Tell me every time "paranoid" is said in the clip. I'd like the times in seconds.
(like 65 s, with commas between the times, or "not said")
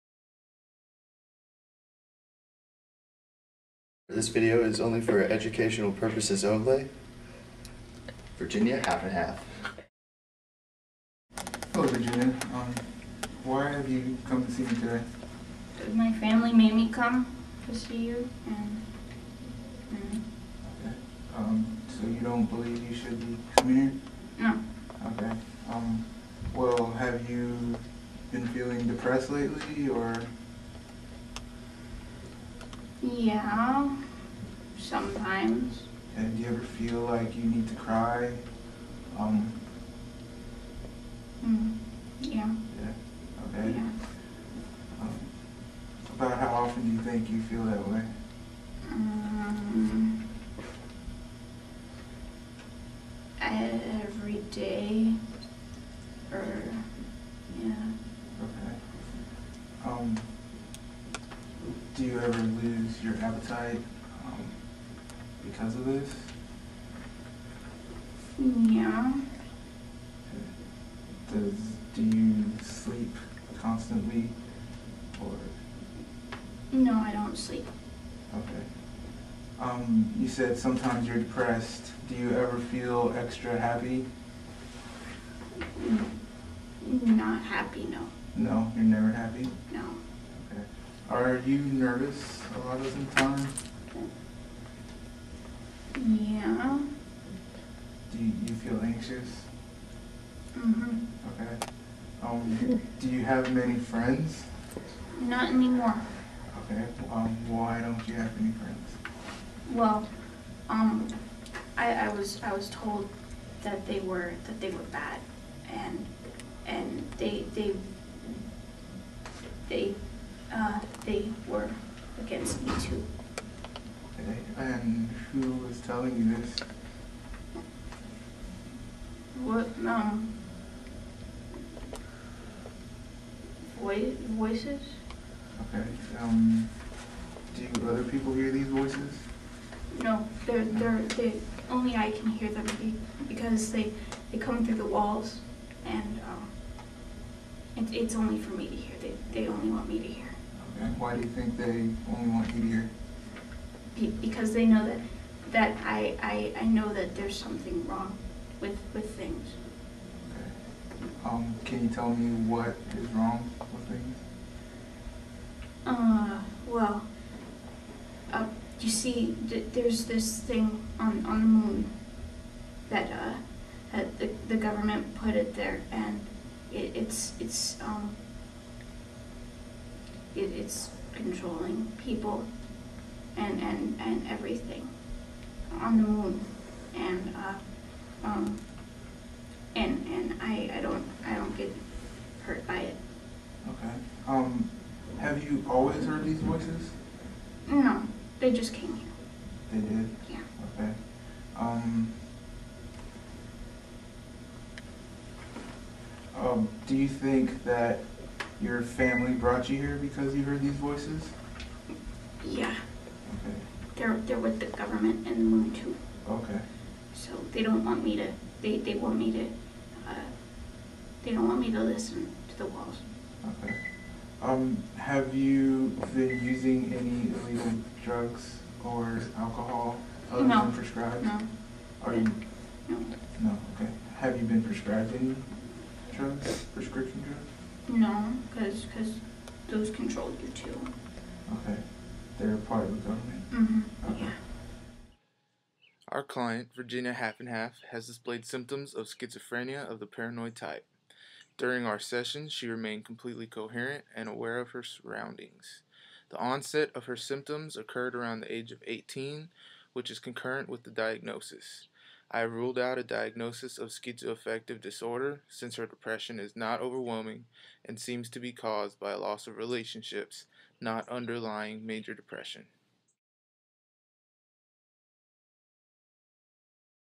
250 s.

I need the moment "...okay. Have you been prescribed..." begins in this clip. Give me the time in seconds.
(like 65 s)
233 s.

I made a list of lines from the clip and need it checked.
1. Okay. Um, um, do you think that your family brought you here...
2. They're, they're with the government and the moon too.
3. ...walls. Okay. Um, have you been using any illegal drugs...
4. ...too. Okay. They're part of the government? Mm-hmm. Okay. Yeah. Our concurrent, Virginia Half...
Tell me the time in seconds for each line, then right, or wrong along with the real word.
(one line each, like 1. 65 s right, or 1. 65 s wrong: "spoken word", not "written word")
1. 200 s right
2. 213 s right
3. 222 s right
4. 240 s wrong: "client", not "concurrent".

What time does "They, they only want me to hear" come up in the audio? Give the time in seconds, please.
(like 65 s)
149 s.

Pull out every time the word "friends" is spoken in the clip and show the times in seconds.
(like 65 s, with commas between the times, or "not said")
103 s, 108 s.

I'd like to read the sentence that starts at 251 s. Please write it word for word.
During our session, she remained completely coherent and aware of her surroundings.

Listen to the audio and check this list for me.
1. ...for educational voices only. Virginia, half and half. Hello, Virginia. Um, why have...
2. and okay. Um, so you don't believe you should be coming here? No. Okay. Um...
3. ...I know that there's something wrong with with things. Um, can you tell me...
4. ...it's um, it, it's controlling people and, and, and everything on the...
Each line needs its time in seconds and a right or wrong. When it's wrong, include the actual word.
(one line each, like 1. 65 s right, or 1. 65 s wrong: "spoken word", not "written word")
1. 4 s wrong: "purposes", not "voices"
2. 19 s right
3. 156 s right
4. 177 s right.